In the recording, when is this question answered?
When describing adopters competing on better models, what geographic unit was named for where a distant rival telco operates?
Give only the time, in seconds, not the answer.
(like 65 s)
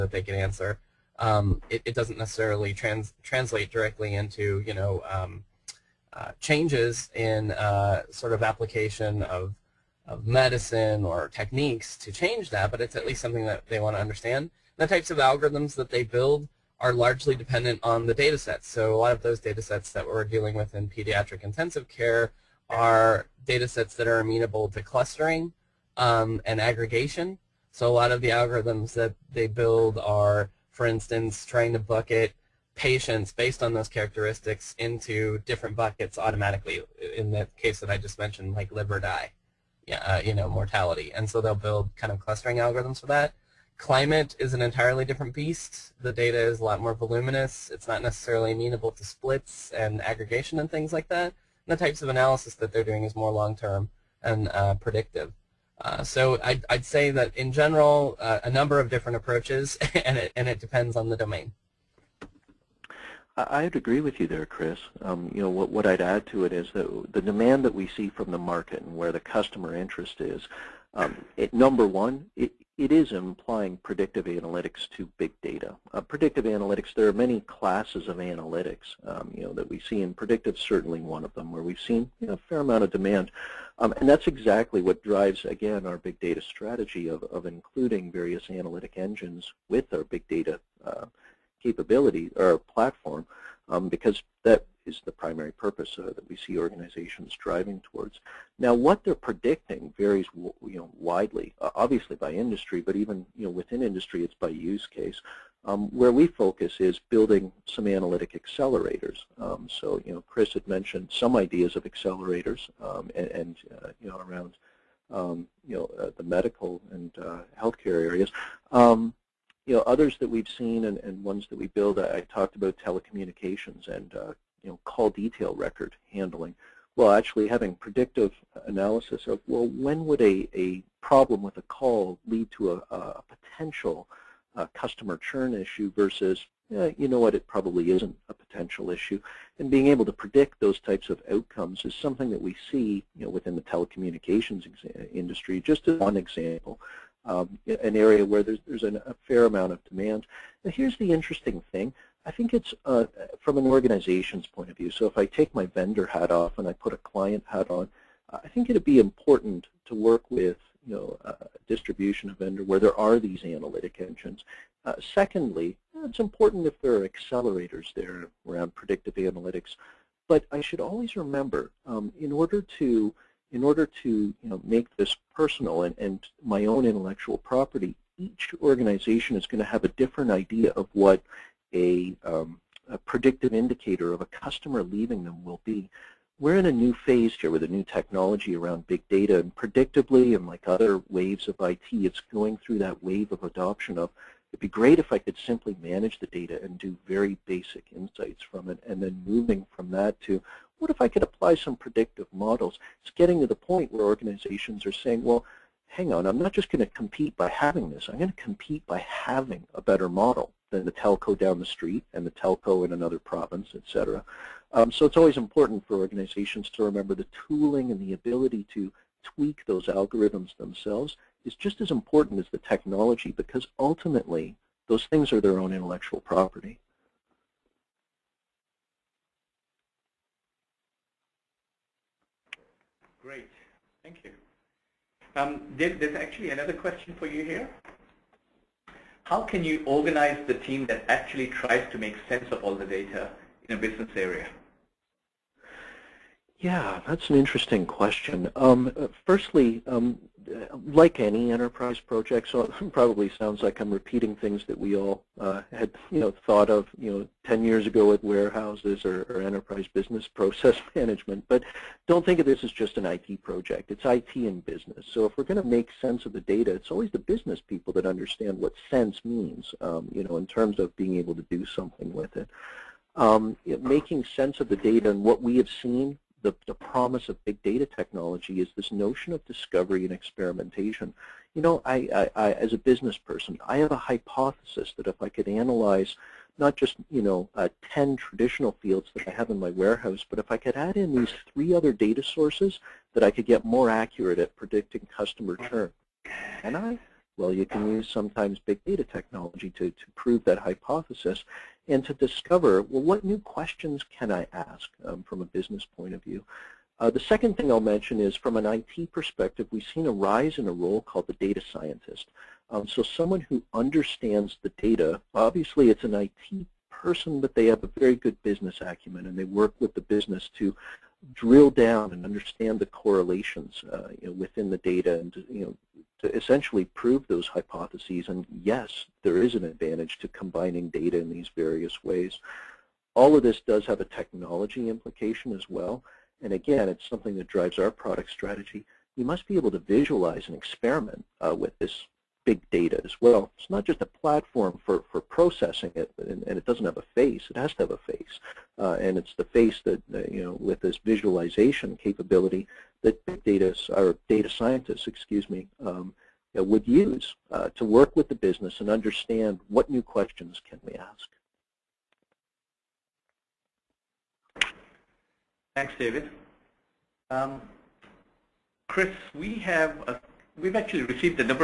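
213 s.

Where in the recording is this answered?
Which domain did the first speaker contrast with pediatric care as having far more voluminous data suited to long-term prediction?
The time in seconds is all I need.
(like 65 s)
43 s.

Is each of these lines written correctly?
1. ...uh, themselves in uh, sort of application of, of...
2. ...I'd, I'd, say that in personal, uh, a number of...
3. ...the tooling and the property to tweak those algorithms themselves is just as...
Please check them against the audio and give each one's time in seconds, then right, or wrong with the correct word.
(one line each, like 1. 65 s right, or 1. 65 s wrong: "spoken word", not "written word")
1. 6 s wrong: "changes", not "themselves"
2. 56 s wrong: "general", not "personal"
3. 217 s wrong: "ability", not "property".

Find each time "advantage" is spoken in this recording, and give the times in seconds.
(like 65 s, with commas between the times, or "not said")
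329 s.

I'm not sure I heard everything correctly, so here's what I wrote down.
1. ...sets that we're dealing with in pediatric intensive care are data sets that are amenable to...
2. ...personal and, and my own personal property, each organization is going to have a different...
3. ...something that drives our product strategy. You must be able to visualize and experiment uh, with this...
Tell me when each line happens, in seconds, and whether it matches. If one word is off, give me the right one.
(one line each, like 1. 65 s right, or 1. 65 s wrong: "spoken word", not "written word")
1. 19 s right
2. 175 s wrong: "intellectual", not "personal"
3. 337 s right.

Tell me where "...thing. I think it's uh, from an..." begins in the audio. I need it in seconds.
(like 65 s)
151 s.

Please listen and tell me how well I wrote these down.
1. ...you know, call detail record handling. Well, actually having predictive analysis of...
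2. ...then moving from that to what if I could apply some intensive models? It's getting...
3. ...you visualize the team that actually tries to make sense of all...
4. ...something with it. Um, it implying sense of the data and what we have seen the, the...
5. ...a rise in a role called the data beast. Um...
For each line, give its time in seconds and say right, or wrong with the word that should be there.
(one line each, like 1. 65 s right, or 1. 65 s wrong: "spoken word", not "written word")
1. 124 s right
2. 199 s wrong: "predictive", not "intensive"
3. 239 s wrong: "organize", not "visualize"
4. 271 s wrong: "making", not "implying"
5. 310 s wrong: "scientist", not "beast".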